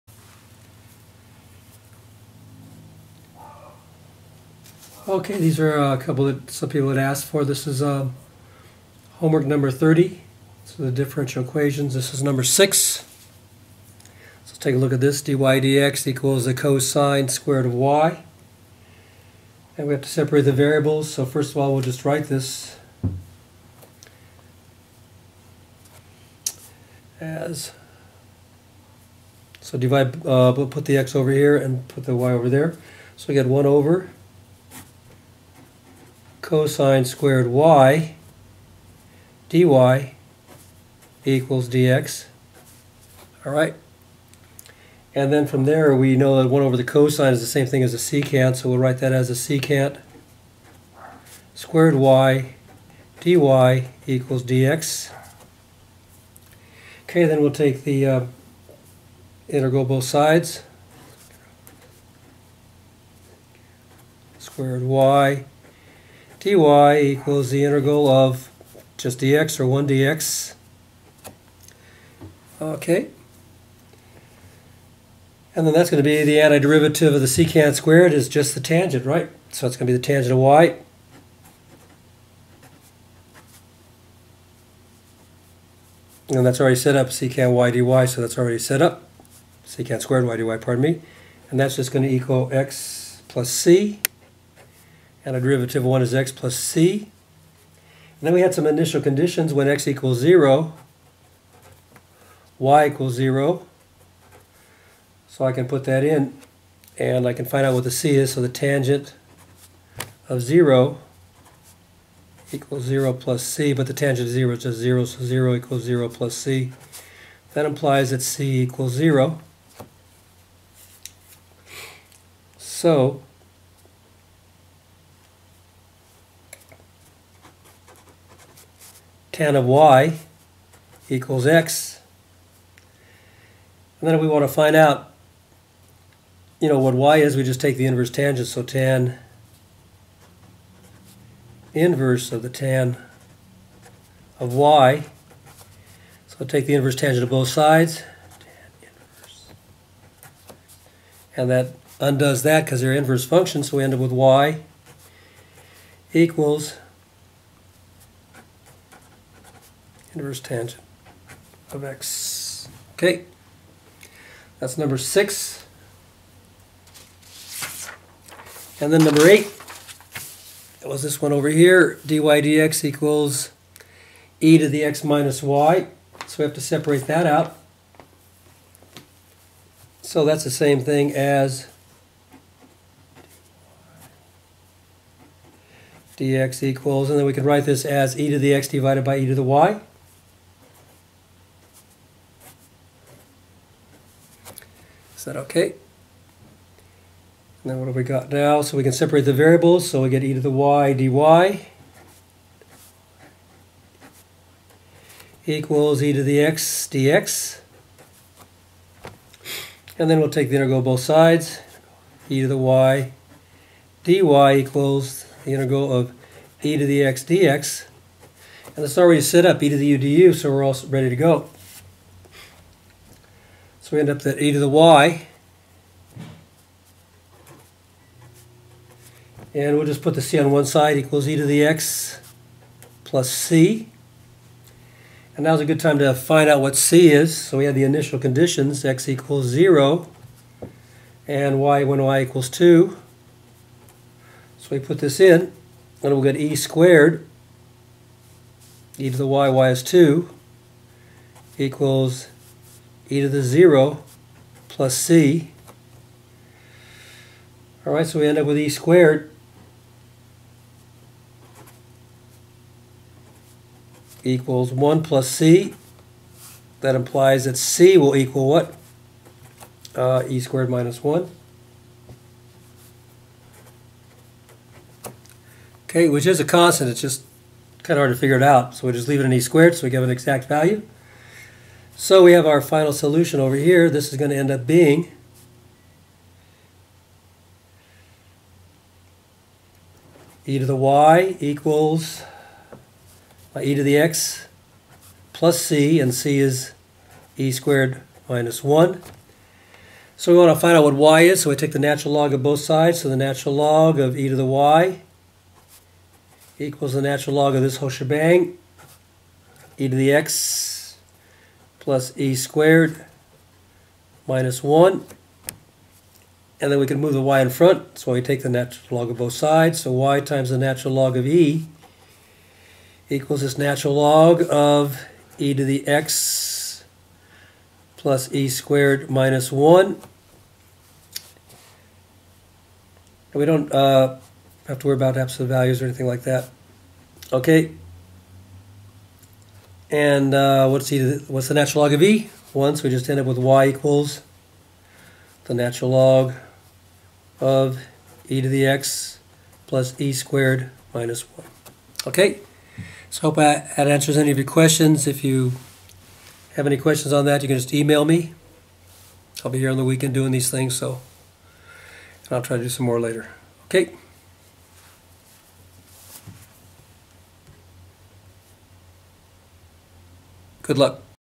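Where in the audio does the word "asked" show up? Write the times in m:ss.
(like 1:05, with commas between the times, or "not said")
0:06.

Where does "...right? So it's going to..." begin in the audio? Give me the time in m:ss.
1:19.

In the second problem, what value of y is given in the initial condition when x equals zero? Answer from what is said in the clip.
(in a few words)
2.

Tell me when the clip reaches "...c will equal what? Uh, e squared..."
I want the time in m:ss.
4:27.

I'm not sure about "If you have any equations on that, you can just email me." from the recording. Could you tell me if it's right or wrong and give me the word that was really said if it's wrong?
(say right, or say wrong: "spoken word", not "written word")
wrong: "questions", not "equations".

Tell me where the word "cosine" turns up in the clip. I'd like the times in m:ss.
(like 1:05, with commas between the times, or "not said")
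0:16, 0:36, 0:46.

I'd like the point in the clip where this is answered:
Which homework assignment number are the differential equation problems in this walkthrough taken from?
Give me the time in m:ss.
0:09.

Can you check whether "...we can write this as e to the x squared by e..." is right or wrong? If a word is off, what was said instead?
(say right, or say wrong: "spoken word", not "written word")
wrong: "divided", not "squared".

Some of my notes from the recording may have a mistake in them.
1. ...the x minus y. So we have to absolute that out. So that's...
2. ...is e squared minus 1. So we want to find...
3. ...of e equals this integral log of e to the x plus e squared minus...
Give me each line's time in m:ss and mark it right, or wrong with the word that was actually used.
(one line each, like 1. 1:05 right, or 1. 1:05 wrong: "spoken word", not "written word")
1. 2:54 wrong: "separate", not "absolute"
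2. 4:56 right
3. 5:21 wrong: "natural", not "integral".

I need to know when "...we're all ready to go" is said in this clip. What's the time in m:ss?
3:40.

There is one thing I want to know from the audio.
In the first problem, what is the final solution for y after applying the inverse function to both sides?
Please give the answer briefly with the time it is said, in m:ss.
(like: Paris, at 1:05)
inverse tangent of x, at 2:40.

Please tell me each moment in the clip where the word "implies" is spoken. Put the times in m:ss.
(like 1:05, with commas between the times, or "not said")
1:57, 4:26.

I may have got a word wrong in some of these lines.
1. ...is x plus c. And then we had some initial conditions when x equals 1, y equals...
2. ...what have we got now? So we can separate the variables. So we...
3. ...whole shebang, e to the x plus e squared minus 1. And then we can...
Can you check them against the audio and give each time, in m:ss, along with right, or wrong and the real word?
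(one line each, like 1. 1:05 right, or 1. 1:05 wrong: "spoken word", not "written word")
1. 1:36 wrong: "0", not "1"
2. 3:17 right
3. 5:07 right.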